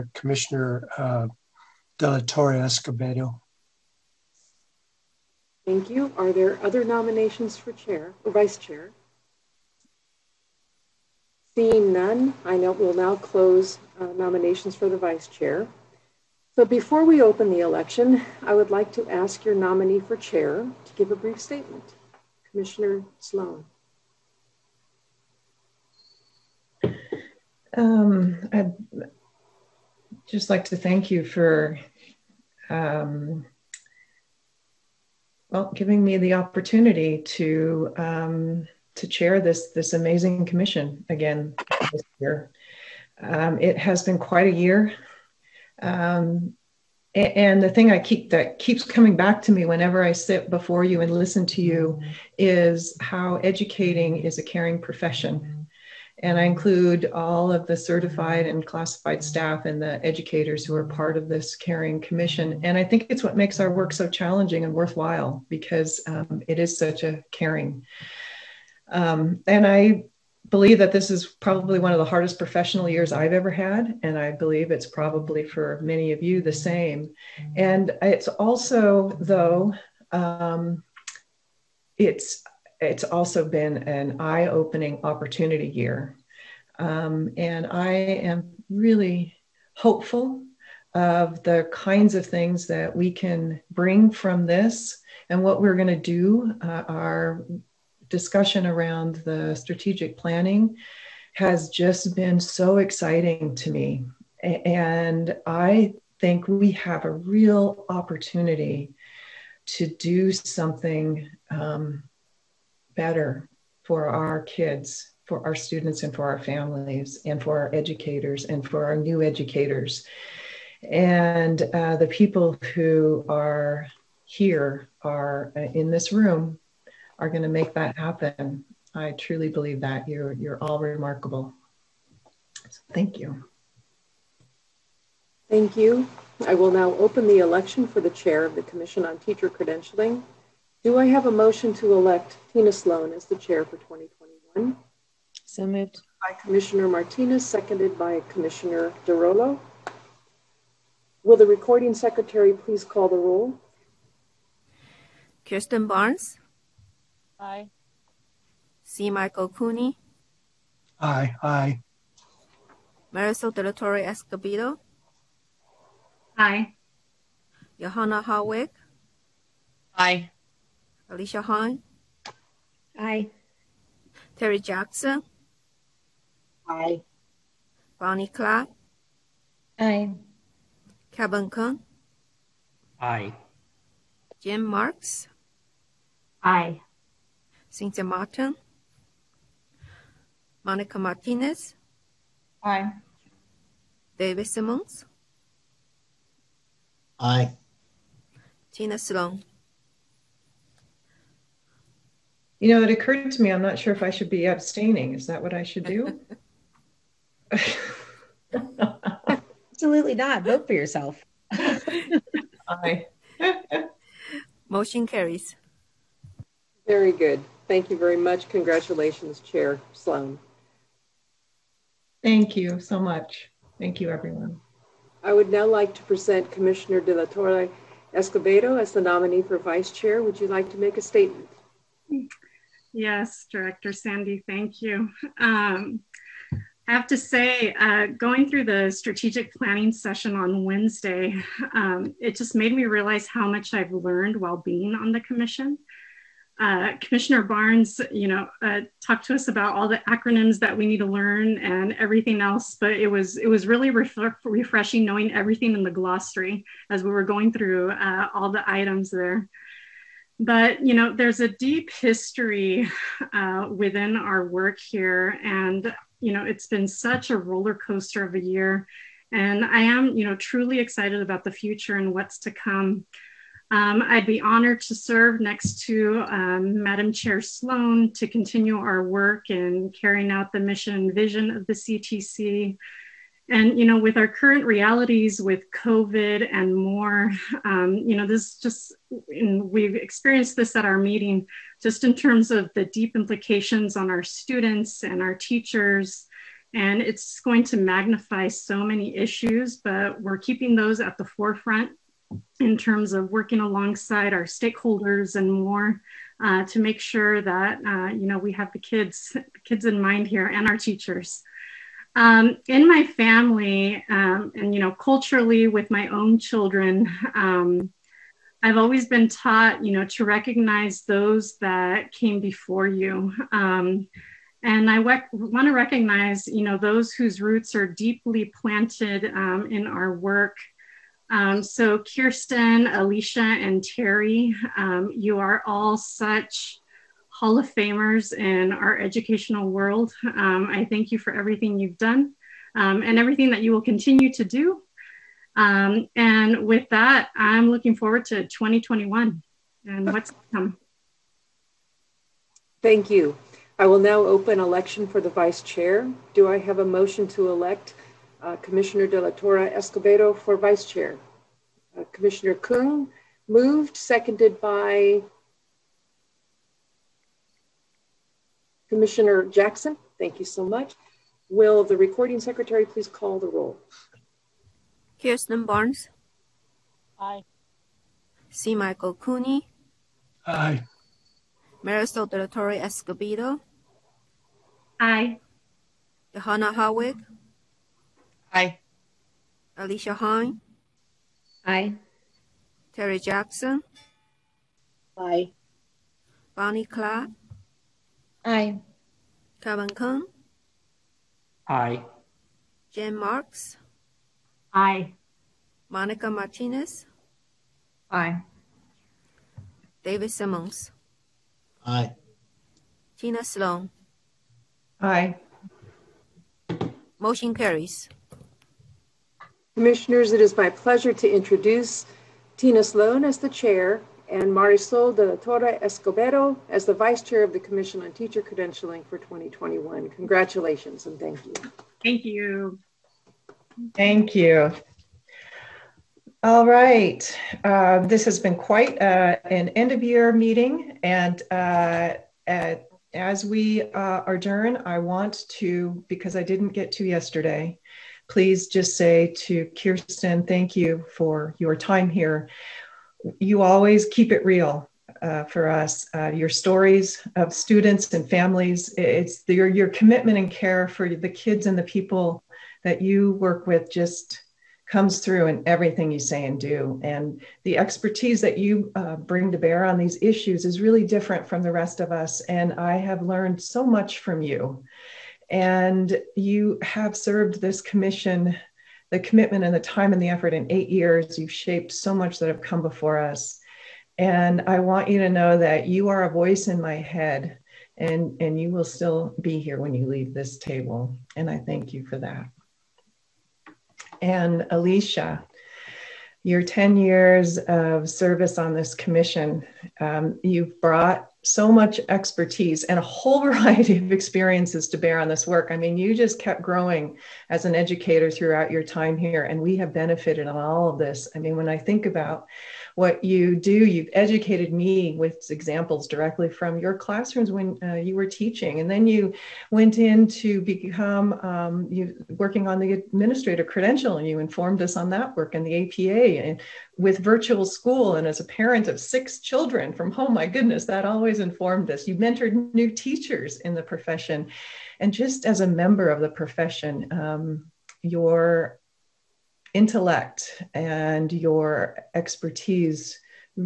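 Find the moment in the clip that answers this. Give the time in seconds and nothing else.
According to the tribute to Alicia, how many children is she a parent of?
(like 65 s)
528 s.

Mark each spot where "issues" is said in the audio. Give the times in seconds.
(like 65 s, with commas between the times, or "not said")
299 s, 470 s.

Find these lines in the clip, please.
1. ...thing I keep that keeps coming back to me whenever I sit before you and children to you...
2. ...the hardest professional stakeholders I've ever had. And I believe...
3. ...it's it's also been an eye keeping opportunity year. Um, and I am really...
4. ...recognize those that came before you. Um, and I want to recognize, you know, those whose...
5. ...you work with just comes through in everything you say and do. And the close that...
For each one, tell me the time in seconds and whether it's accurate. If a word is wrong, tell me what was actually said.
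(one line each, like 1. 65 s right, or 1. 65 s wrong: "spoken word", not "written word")
1. 47 s wrong: "listen", not "children"
2. 71 s wrong: "years", not "stakeholders"
3. 81 s wrong: "opening", not "keeping"
4. 320 s right
5. 463 s wrong: "expertise", not "close".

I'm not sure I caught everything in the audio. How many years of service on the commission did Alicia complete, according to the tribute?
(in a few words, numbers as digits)
10.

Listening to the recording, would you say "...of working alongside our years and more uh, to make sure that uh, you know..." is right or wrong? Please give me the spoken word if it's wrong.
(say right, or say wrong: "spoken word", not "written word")
wrong: "stakeholders", not "years".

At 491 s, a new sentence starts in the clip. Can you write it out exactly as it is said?
And I thank you for that.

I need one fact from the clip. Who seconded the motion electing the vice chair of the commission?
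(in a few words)
Commissioner Jackson.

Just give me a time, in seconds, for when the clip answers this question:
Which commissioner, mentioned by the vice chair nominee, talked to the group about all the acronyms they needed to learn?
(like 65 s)
246 s.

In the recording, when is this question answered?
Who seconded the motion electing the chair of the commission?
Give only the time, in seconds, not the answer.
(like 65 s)
148 s.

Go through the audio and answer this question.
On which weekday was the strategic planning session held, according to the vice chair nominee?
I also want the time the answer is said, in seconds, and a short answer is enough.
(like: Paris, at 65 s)
Wednesday, at 240 s.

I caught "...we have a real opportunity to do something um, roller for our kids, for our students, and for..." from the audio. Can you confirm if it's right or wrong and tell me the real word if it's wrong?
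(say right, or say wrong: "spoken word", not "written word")
wrong: "better", not "roller".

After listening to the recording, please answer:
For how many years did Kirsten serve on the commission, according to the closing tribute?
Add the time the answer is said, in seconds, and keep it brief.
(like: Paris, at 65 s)
8, at 480 s.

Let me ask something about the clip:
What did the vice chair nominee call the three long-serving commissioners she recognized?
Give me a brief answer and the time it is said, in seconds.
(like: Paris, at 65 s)
Hall of Famers, at 337 s.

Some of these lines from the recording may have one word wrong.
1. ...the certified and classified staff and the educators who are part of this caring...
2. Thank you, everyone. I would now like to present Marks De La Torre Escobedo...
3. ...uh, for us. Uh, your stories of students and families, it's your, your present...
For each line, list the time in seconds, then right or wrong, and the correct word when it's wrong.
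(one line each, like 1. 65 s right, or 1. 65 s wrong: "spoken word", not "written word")
1. 57 s right
2. 223 s wrong: "Commissioner", not "Marks"
3. 455 s wrong: "commitment", not "present".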